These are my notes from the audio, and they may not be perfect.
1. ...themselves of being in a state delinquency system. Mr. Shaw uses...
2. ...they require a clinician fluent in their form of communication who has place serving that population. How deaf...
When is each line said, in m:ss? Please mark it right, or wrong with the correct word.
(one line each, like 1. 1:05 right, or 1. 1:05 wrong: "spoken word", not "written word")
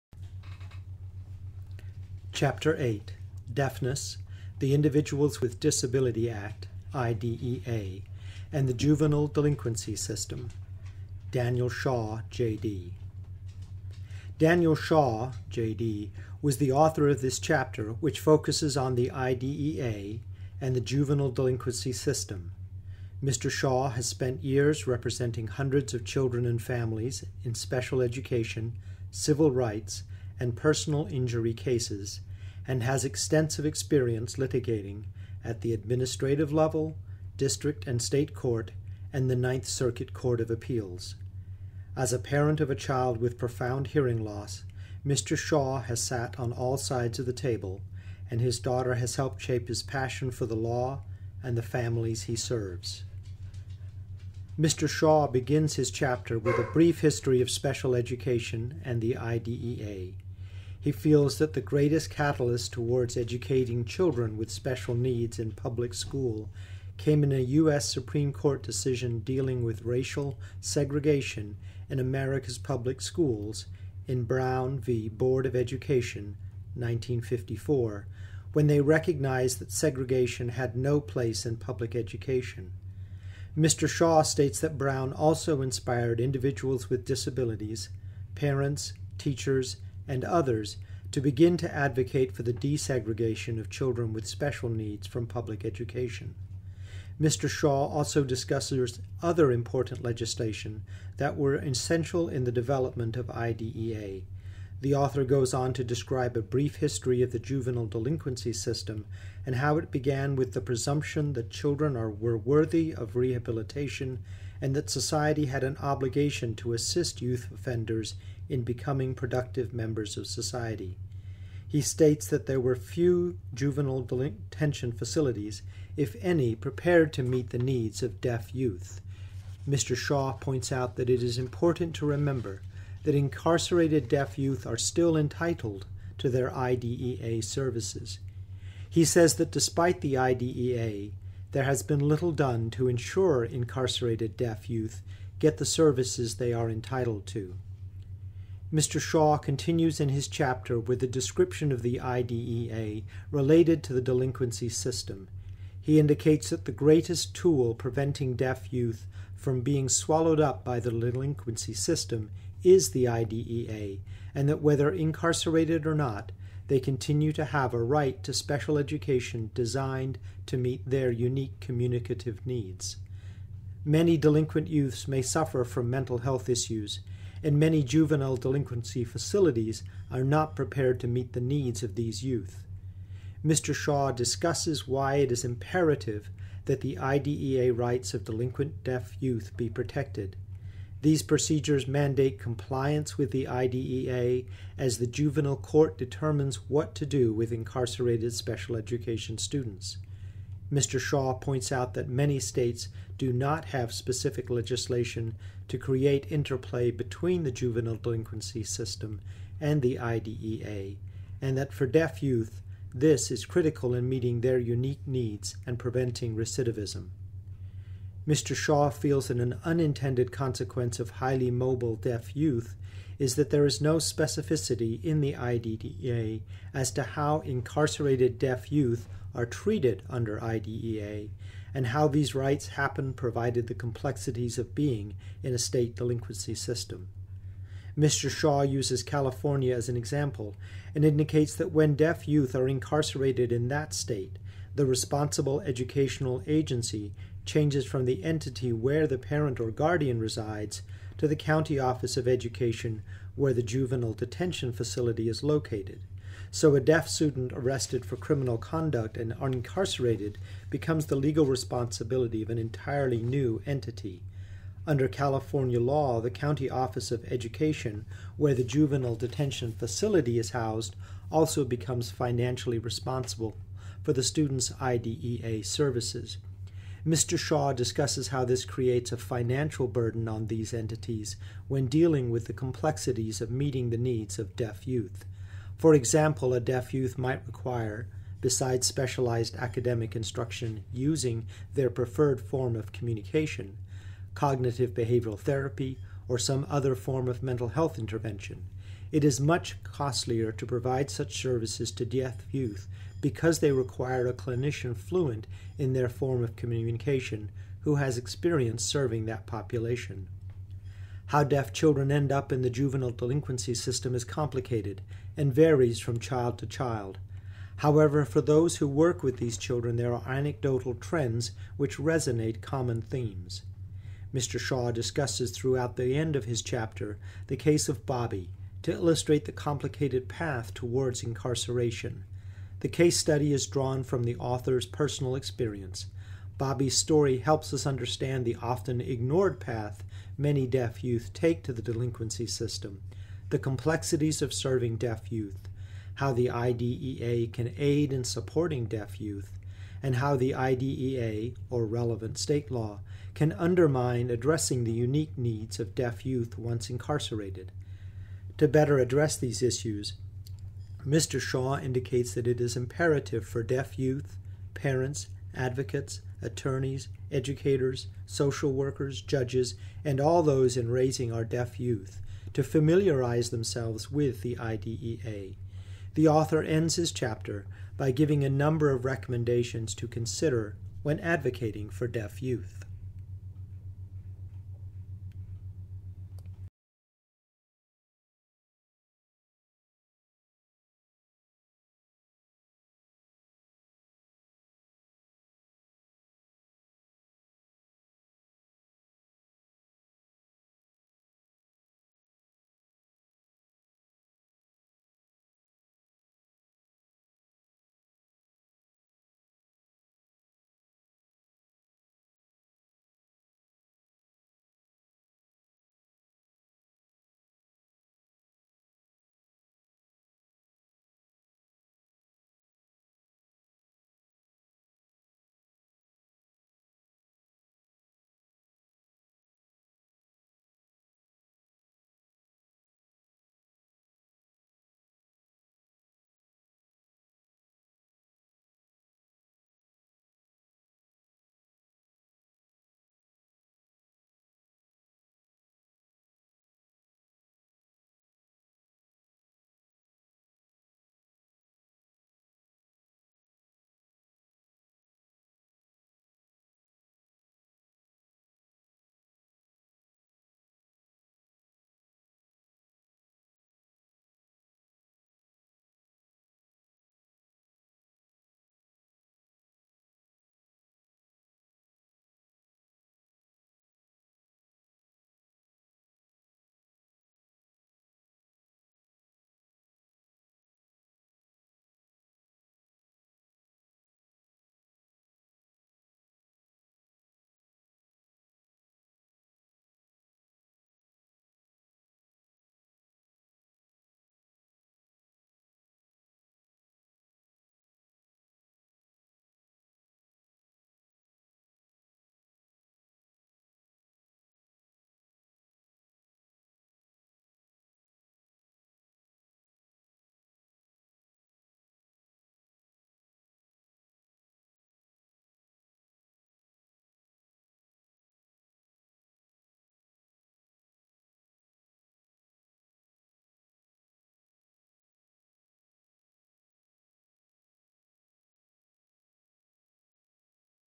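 1. 3:53 wrong: "complexities", not "themselves"
2. 5:03 wrong: "experience", not "place".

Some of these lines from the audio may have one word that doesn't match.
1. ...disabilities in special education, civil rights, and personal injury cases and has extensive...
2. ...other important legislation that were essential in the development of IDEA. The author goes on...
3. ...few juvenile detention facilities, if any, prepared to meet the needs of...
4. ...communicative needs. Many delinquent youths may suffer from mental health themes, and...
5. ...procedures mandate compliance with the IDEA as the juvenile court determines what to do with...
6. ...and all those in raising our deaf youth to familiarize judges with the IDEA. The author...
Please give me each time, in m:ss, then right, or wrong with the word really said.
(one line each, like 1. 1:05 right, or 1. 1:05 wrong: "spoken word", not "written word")
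1. 0:26 wrong: "families", not "disabilities"
2. 1:39 right
3. 2:02 right
4. 2:51 wrong: "issues", not "themes"
5. 3:11 right
6. 6:10 wrong: "themselves", not "judges".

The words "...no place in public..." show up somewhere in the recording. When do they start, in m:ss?
1:20.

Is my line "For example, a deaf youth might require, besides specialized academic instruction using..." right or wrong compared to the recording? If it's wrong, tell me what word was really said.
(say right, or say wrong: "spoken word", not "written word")
right.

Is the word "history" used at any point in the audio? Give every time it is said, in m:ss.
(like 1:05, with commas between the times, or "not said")
0:57, 1:46.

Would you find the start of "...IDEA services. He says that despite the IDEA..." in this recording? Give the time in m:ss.
2:16.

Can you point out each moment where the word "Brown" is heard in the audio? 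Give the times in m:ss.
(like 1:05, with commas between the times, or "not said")
1:14, 1:24.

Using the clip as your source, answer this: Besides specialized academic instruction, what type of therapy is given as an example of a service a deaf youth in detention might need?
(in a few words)
cognitive behavioral therapy.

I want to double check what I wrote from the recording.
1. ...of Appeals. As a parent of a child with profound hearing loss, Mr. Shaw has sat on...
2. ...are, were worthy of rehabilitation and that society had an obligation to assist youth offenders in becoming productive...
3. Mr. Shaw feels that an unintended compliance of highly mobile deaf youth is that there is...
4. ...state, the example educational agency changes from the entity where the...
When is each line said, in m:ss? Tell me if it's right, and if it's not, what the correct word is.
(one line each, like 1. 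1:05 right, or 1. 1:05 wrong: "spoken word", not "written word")
1. 0:40 right
2. 1:51 right
3. 3:38 wrong: "consequence", not "compliance"
4. 4:03 wrong: "responsible", not "example".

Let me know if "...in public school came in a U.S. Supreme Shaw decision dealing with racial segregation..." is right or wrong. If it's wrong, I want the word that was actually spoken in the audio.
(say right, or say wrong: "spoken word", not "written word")
wrong: "Court", not "Shaw".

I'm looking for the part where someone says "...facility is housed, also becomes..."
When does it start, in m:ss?
4:29.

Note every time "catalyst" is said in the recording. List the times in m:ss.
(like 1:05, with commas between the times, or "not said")
1:02.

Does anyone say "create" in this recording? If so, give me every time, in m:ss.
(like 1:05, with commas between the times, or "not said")
3:25, 4:38.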